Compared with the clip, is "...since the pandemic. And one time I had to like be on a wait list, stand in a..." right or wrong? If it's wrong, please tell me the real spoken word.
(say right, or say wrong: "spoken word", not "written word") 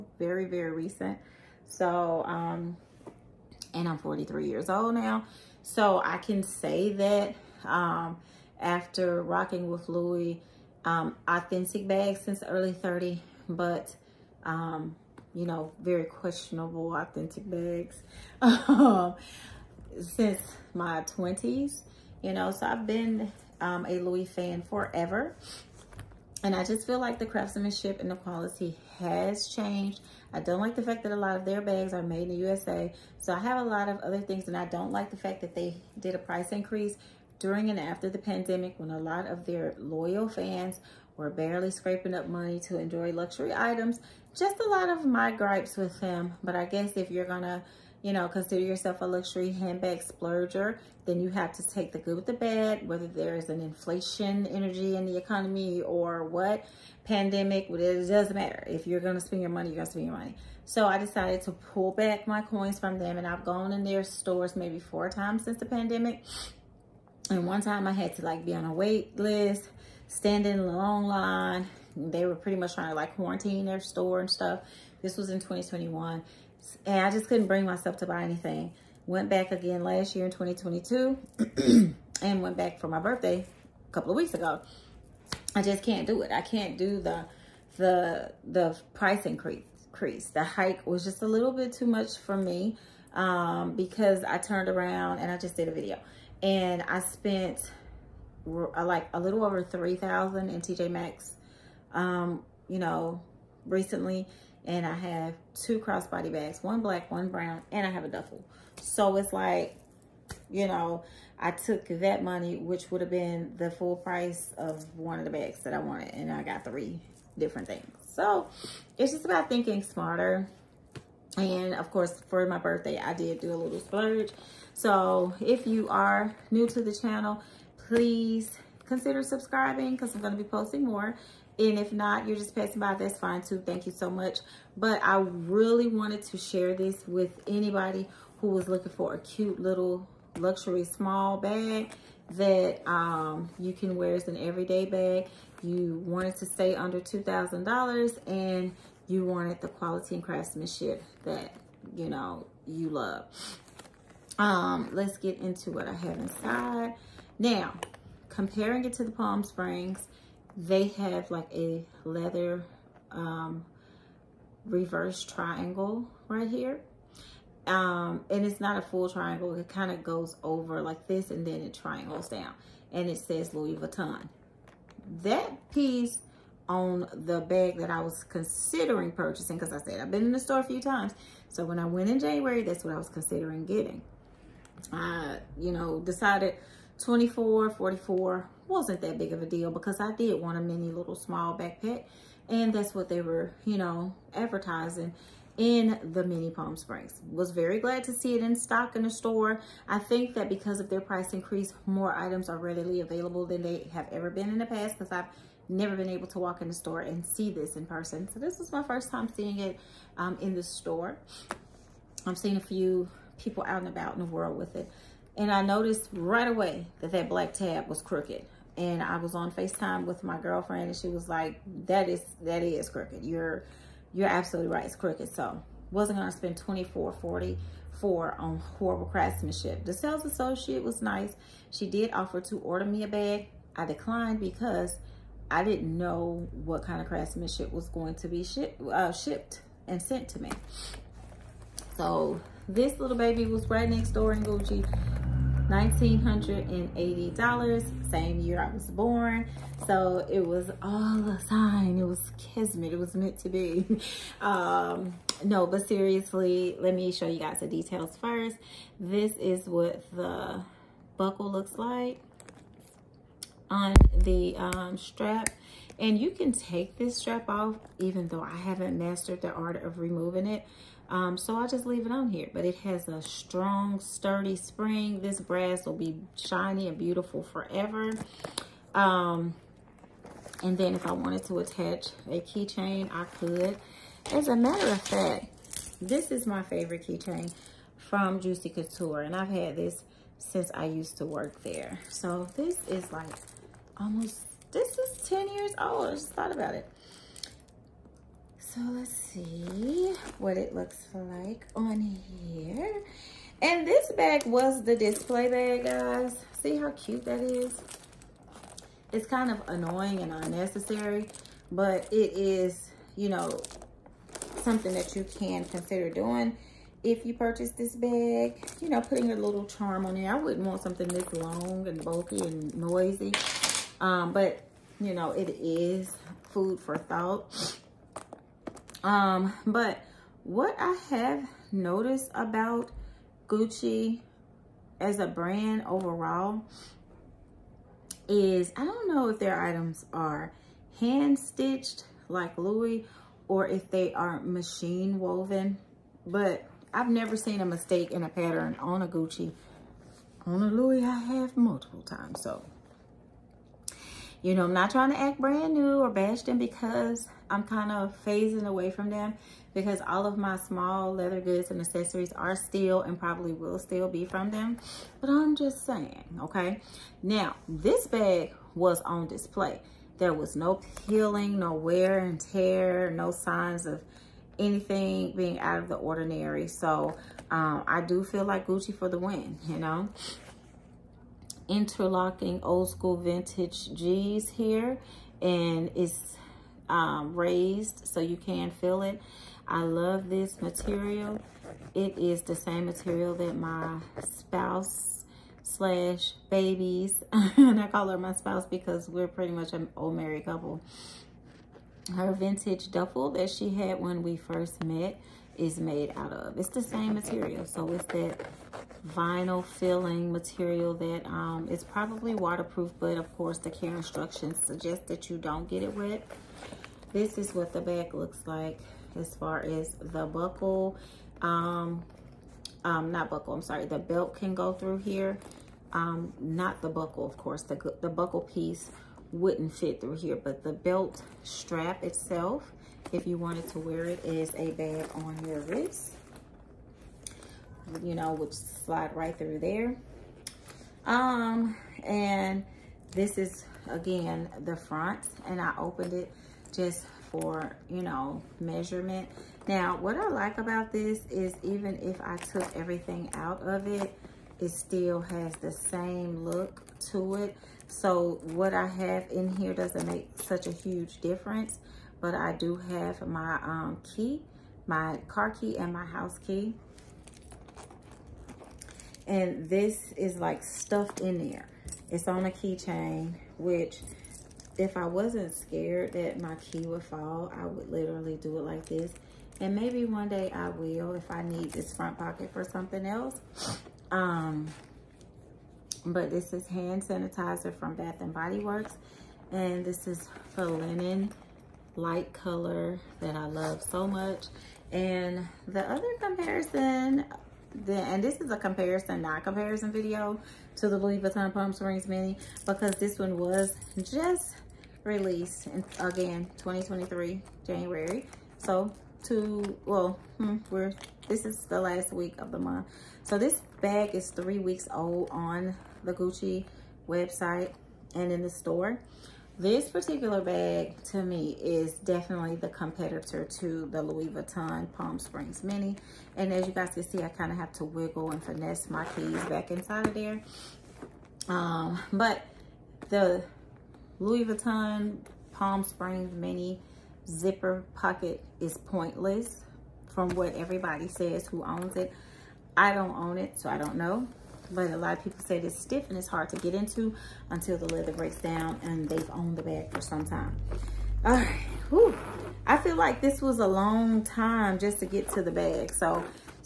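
right.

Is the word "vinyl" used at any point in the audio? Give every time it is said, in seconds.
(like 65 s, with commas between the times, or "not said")
409 s.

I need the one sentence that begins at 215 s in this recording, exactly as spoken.
And I noticed right away that that black tab was crooked.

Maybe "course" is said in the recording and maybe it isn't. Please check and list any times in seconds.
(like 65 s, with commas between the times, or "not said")
121 s, 413 s, 427 s.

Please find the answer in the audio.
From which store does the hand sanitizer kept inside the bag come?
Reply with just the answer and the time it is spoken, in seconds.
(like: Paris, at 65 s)
Bath and Body Works, at 487 s.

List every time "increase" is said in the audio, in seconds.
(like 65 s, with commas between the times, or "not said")
36 s, 89 s, 201 s.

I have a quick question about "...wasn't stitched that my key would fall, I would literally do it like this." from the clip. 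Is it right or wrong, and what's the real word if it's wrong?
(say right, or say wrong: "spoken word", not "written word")
wrong: "scared", not "stitched".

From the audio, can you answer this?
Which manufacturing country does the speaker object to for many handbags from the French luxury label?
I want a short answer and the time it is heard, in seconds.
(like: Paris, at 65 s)
USA, at 32 s.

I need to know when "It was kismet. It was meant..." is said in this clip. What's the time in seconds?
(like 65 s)
251 s.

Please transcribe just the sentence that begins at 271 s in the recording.
Um, so I will just leave it on here.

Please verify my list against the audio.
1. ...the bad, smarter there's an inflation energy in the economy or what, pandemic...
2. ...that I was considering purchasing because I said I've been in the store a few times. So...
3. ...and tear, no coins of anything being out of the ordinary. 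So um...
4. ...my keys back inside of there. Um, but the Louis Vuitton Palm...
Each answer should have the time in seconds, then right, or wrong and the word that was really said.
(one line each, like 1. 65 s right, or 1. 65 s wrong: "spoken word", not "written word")
1. 52 s wrong: "whether", not "smarter"
2. 177 s right
3. 372 s wrong: "signs", not "coins"
4. 528 s right.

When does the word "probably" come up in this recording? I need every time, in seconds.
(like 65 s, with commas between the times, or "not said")
363 s, 411 s.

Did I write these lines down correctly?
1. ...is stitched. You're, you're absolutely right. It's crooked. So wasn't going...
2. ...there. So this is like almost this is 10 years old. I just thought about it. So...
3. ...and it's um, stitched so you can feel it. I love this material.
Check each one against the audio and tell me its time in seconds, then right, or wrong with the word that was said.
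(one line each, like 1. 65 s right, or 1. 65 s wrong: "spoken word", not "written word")
1. 222 s wrong: "crooked", not "stitched"
2. 291 s right
3. 385 s wrong: "raised", not "stitched".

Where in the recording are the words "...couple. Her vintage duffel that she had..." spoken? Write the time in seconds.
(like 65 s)
400 s.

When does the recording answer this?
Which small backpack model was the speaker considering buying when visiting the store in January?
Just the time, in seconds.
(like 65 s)
196 s.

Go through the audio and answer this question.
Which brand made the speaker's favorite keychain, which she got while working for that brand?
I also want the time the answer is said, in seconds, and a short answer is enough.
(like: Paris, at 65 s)
Juicy Couture, at 288 s.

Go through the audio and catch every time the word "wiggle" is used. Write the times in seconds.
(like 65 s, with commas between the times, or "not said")
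527 s.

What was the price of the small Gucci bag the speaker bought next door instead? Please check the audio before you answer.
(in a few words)
$1,980.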